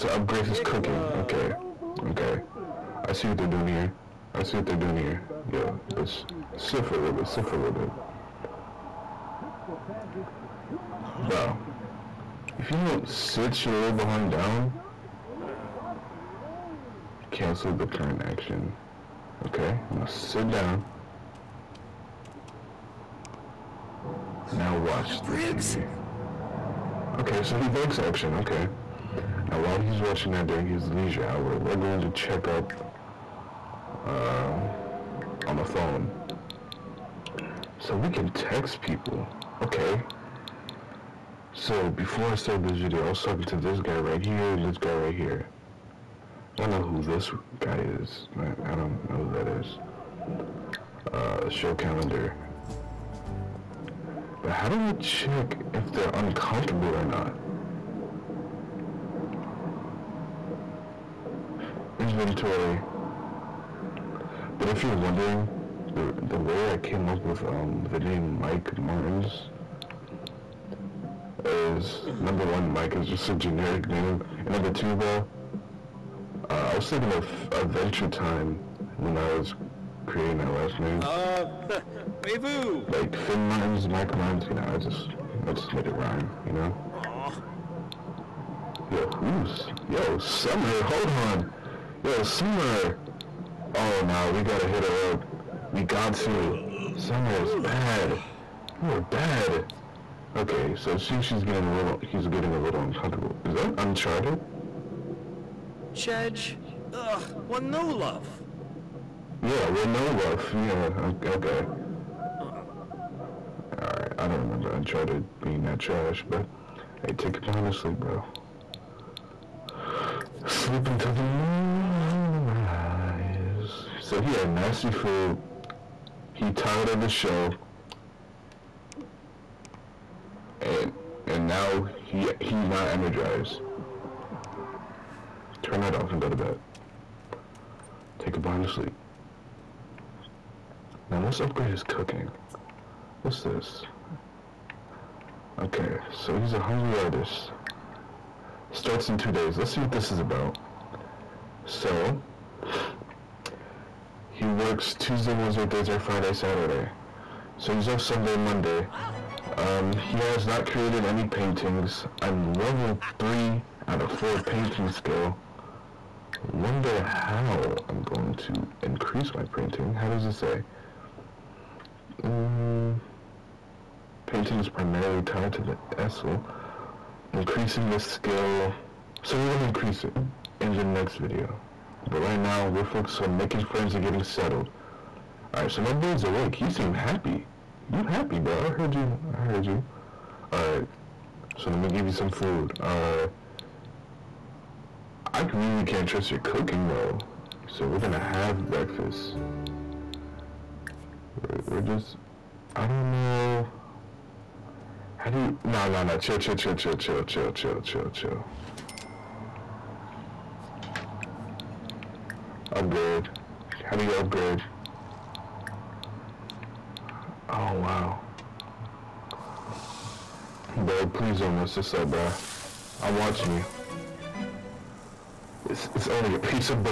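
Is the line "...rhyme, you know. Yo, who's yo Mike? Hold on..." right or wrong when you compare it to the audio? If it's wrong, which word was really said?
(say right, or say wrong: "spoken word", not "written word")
wrong: "Summer", not "Mike".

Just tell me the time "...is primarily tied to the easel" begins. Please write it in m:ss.
2:54.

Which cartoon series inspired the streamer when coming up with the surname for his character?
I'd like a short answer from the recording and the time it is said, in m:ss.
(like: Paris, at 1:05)
Adventure Time, at 1:17.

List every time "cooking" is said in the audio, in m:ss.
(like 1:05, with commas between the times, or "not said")
0:00, 2:21, 3:16.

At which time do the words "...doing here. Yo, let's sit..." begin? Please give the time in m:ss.
0:04.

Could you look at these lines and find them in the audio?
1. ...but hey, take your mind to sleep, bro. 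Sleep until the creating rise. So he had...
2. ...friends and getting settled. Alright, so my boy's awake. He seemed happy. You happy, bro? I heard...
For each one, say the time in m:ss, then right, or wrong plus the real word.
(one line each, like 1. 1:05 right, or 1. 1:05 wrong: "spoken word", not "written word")
1. 1:56 wrong: "morning", not "creating"
2. 3:03 right.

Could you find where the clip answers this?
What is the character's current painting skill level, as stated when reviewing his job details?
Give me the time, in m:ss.
2:42.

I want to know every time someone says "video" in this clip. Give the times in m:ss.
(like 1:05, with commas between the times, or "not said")
0:42, 3:01.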